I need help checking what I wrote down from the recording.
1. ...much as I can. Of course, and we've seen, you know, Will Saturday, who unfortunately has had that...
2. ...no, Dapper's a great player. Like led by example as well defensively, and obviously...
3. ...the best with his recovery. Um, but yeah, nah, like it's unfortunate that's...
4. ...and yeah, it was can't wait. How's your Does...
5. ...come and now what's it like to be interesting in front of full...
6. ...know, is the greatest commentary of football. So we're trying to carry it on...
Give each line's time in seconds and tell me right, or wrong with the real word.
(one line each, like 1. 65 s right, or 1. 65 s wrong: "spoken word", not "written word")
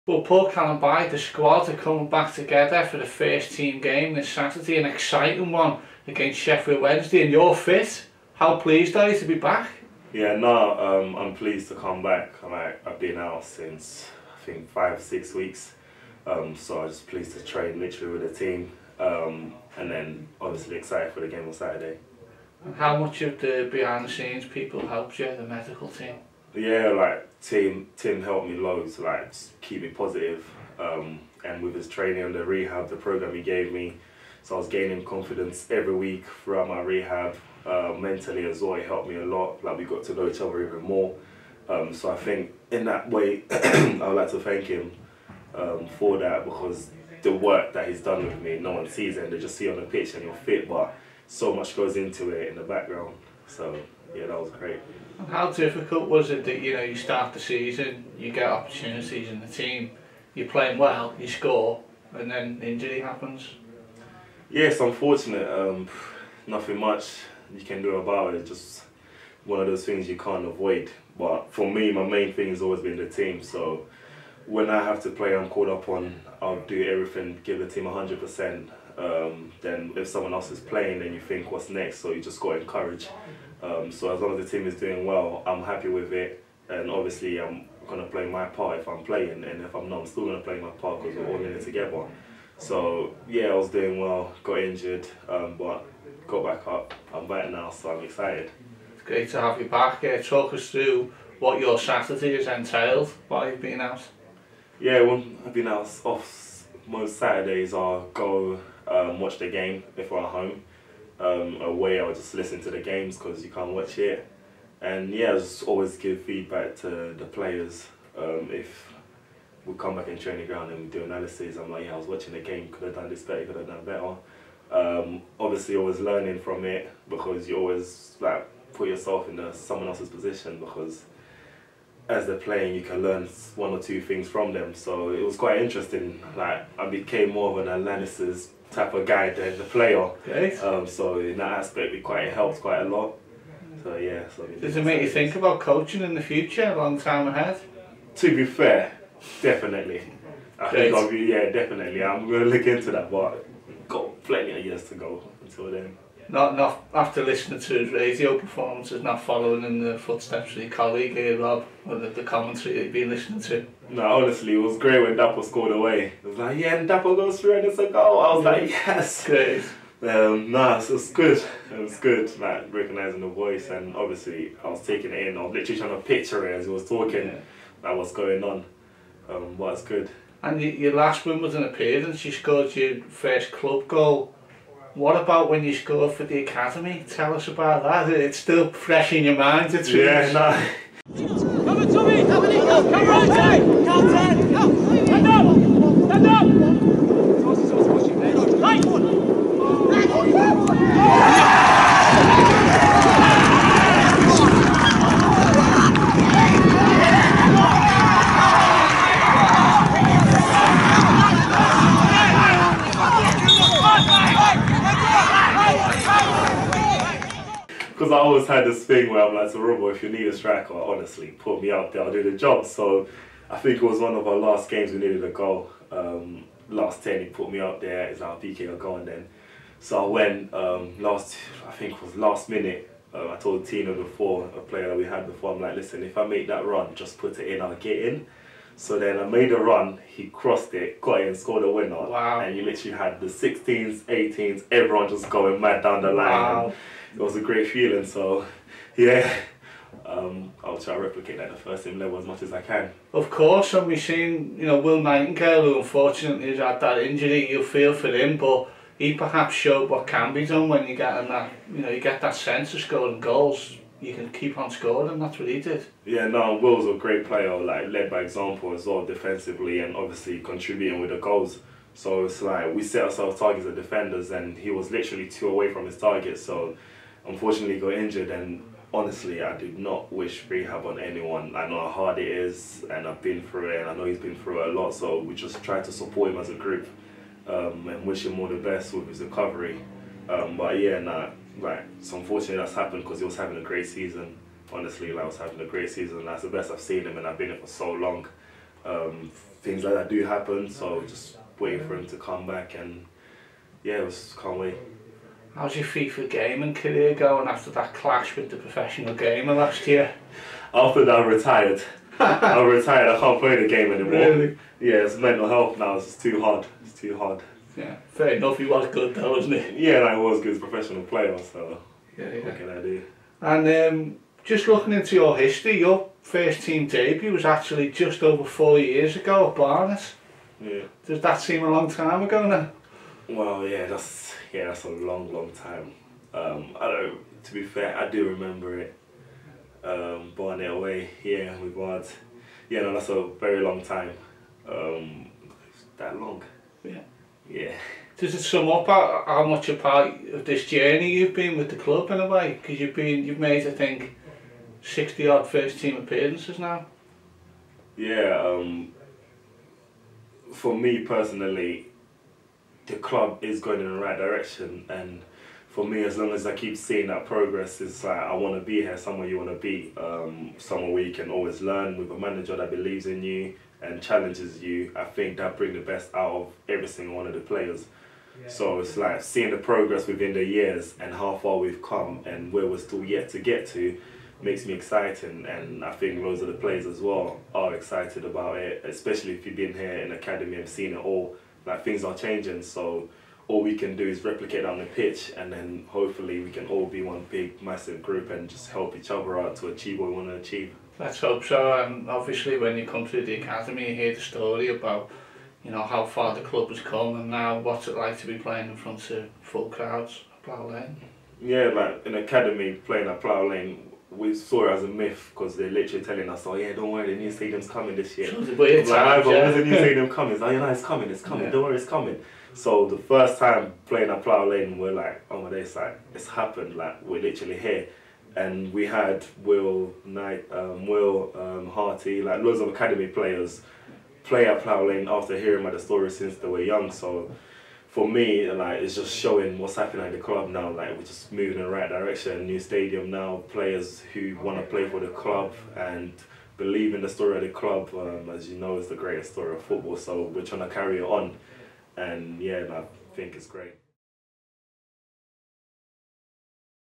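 1. 252 s wrong: "Nightingale", not "Saturday"
2. 266 s wrong: "Will", not "Dapper"
3. 288 s right
4. 302 s wrong: "FIFA", not "Does"
5. 406 s wrong: "playing", not "interesting"
6. 448 s wrong: "story", not "commentary".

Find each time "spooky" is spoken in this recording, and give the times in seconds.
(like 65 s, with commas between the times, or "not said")
not said.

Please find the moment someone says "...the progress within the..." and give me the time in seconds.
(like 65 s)
379 s.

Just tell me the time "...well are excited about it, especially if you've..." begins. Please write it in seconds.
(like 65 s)
386 s.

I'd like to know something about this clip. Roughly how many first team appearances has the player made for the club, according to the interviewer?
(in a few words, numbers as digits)
60.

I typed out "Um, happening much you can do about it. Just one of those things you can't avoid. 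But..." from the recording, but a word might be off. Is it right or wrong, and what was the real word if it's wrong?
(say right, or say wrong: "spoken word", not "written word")
wrong: "nothing", not "happening".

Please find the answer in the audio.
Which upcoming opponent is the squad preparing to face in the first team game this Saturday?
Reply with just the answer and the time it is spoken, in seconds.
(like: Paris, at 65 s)
Sheffield Wednesday, at 6 s.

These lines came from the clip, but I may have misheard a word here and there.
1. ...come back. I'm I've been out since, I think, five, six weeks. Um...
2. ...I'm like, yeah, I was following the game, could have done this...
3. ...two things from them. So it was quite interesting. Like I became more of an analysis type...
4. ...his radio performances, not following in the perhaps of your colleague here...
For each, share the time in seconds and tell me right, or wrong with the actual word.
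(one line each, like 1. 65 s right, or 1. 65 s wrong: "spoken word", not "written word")
1. 11 s right
2. 121 s wrong: "watching", not "following"
3. 133 s right
4. 157 s wrong: "footsteps", not "perhaps".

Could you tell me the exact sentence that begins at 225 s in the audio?
Um, last 10, he put me out there, it's like, PK, I'll go on then.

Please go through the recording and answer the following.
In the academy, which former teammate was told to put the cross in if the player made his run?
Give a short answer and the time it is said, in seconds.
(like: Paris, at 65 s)
Tina, at 233 s.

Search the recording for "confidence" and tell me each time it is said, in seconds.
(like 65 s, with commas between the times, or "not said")
35 s.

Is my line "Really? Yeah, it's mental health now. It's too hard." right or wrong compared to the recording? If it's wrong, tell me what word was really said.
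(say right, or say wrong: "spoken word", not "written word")
right.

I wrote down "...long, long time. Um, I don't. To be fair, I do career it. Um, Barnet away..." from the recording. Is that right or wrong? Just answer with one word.
wrong.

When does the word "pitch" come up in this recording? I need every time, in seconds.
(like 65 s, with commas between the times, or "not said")
49 s, 394 s.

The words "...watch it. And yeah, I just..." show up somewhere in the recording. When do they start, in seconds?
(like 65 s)
113 s.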